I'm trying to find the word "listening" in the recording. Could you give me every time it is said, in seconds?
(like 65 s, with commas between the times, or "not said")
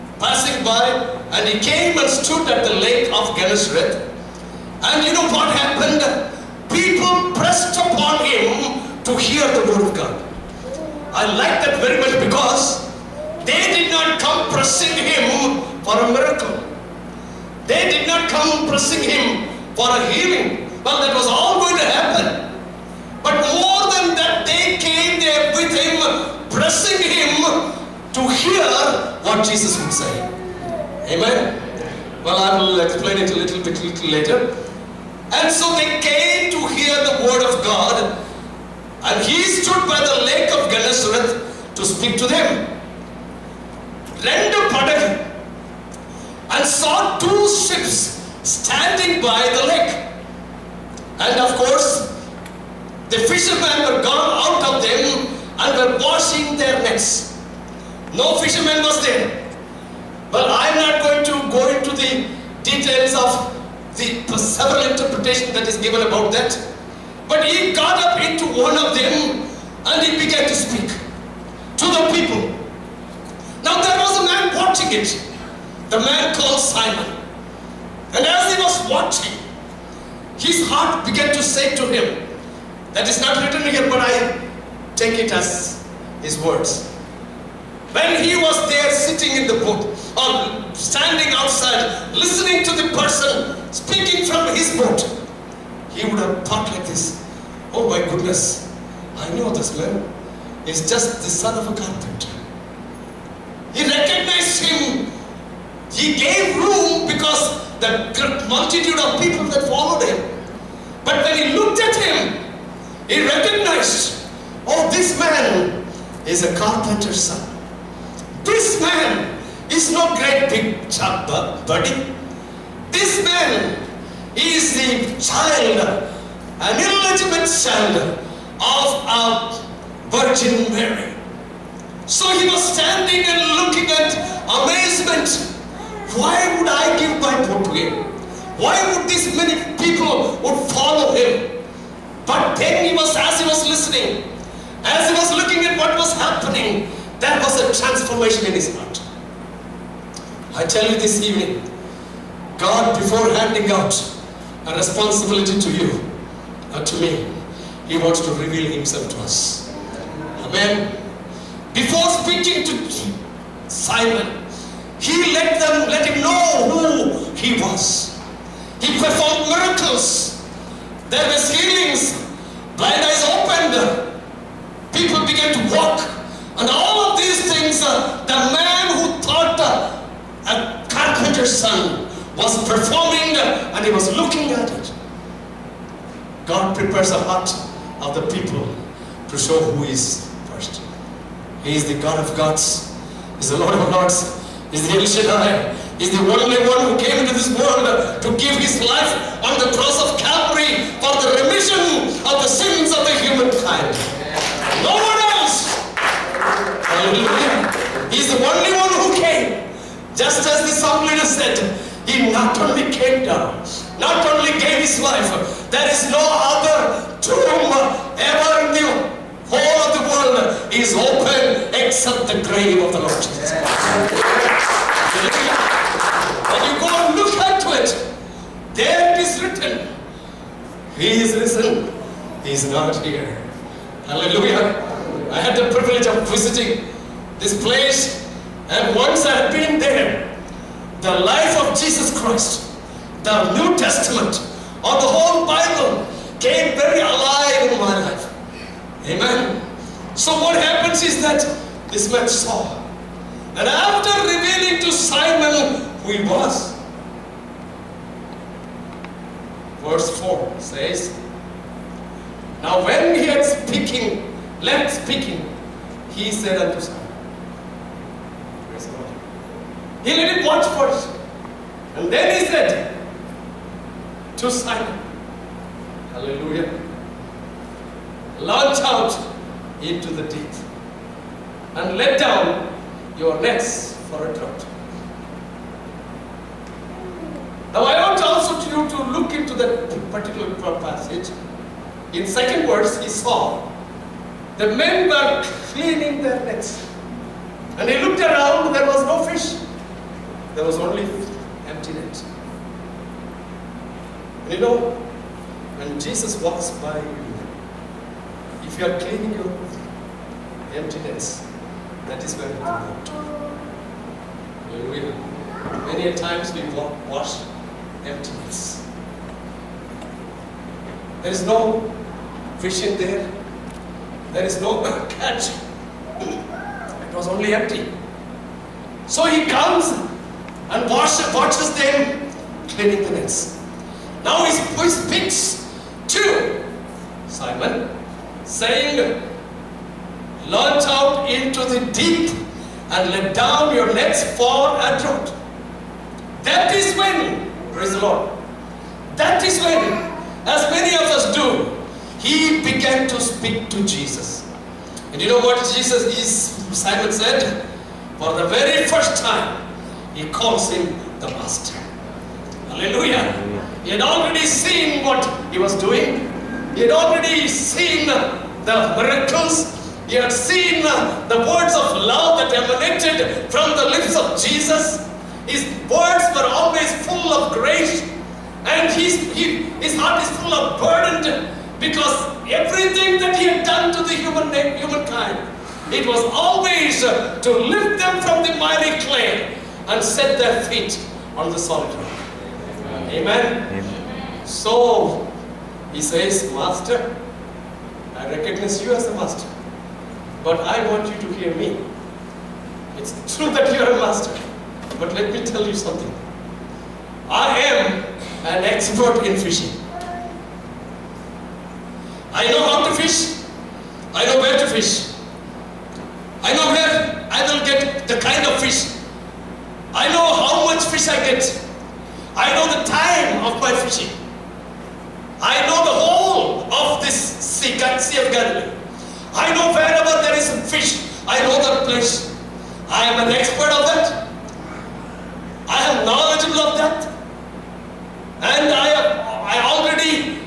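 92 s, 143 s.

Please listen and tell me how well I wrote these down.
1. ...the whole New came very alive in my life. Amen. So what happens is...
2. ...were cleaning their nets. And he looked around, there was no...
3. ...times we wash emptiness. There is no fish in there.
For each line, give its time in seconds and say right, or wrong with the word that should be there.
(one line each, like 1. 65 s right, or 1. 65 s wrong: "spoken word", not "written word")
1. 244 s wrong: "Bible", not "New"
2. 295 s right
3. 316 s right.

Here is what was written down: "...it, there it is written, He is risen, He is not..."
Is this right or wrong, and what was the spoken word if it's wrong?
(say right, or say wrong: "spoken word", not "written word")
right.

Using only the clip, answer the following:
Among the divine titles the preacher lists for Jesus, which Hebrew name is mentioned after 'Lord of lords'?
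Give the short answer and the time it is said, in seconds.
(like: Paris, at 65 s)
El Shaddai, at 194 s.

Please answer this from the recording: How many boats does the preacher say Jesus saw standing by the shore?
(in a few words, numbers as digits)
2.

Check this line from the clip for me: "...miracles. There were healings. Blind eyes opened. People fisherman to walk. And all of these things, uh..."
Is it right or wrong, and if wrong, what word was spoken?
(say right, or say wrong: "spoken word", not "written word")
wrong: "began", not "fisherman".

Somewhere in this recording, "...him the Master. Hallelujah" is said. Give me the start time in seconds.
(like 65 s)
360 s.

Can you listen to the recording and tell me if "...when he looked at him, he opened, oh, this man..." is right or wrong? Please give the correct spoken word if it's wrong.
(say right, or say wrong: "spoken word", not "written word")
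wrong: "recognized", not "opened".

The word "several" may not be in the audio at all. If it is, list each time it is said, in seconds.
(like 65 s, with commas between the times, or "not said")
64 s.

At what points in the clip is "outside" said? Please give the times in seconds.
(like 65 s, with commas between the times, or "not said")
91 s.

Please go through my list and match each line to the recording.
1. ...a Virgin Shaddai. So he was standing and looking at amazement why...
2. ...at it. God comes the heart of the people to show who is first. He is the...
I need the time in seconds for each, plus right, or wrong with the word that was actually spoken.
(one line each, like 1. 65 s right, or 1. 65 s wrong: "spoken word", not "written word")
1. 129 s wrong: "Mary", not "Shaddai"
2. 184 s wrong: "prepares", not "comes".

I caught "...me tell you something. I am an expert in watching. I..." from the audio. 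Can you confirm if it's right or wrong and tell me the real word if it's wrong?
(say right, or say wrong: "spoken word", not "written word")
wrong: "fishing", not "watching".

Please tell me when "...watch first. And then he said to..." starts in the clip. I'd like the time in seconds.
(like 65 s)
270 s.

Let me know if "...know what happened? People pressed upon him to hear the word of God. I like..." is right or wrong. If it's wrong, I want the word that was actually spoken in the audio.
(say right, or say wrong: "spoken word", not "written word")
right.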